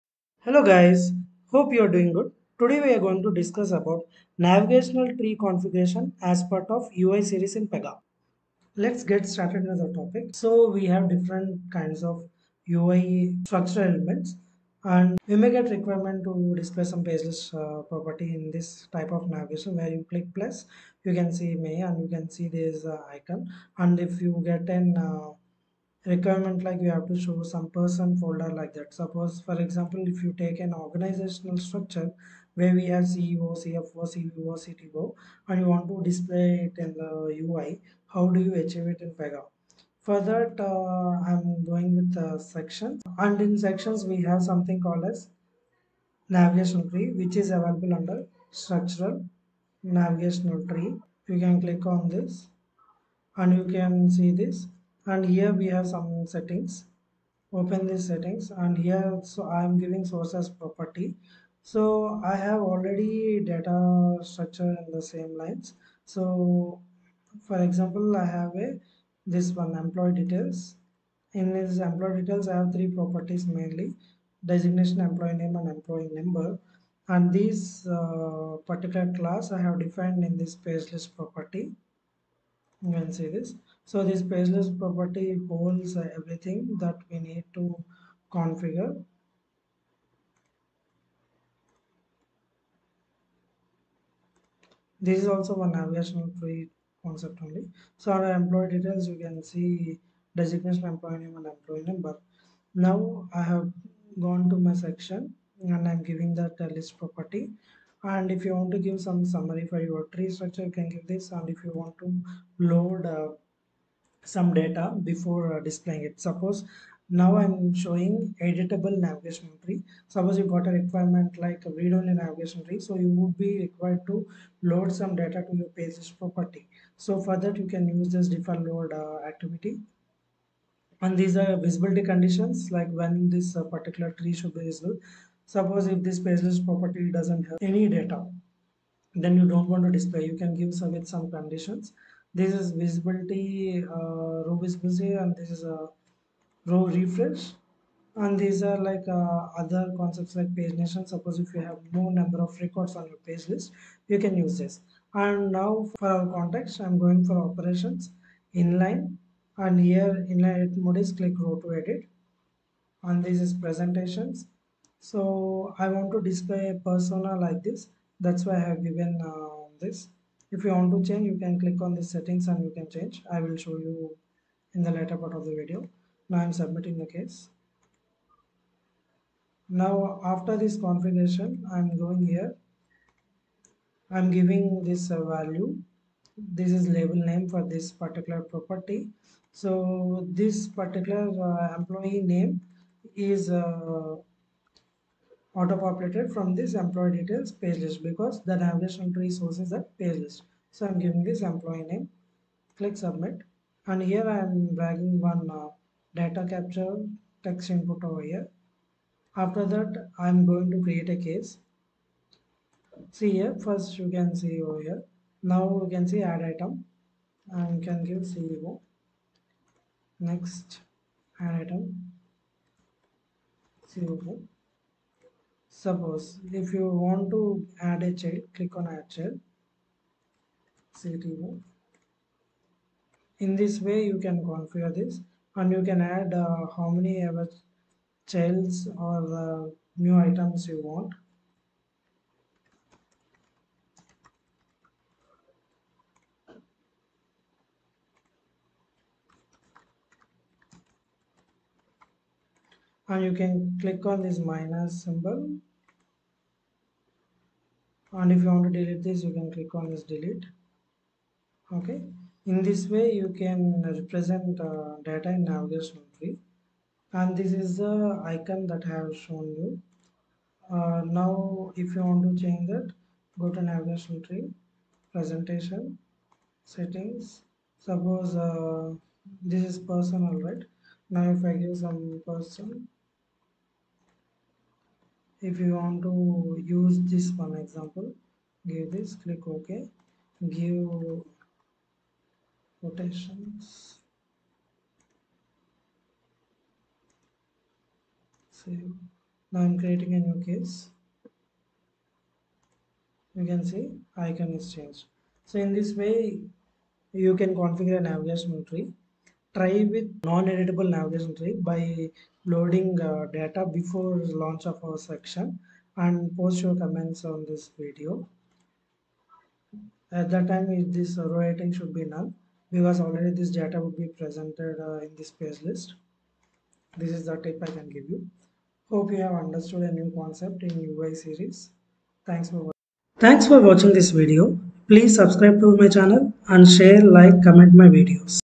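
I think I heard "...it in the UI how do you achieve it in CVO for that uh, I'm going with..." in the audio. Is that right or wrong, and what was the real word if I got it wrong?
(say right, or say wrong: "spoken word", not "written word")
wrong: "Pega", not "CVO".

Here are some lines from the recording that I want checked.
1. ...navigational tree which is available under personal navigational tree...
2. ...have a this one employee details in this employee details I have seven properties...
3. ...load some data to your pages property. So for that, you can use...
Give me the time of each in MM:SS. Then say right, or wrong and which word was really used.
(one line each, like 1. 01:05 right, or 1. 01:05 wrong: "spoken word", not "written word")
1. 00:46 wrong: "structural", not "personal"
2. 01:08 wrong: "three", not "seven"
3. 02:04 right.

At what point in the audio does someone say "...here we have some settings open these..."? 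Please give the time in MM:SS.
00:55.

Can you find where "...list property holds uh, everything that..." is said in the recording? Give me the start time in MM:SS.
01:24.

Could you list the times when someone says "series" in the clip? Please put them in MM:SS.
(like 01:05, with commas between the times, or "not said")
00:07, 05:31.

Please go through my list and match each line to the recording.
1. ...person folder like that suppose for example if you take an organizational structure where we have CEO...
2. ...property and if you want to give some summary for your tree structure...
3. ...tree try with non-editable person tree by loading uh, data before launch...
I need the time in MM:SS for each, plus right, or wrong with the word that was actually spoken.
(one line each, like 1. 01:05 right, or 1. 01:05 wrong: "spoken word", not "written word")
1. 00:27 right
2. 01:46 right
3. 05:08 wrong: "navigation", not "person".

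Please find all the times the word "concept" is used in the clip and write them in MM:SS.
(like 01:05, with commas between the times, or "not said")
01:37, 02:29, 05:30.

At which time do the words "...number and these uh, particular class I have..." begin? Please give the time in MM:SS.
01:16.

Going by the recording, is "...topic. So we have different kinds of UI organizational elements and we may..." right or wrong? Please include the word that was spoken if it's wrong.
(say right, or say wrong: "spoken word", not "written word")
wrong: "structural", not "organizational".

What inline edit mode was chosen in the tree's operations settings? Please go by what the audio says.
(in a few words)
Click row to edit.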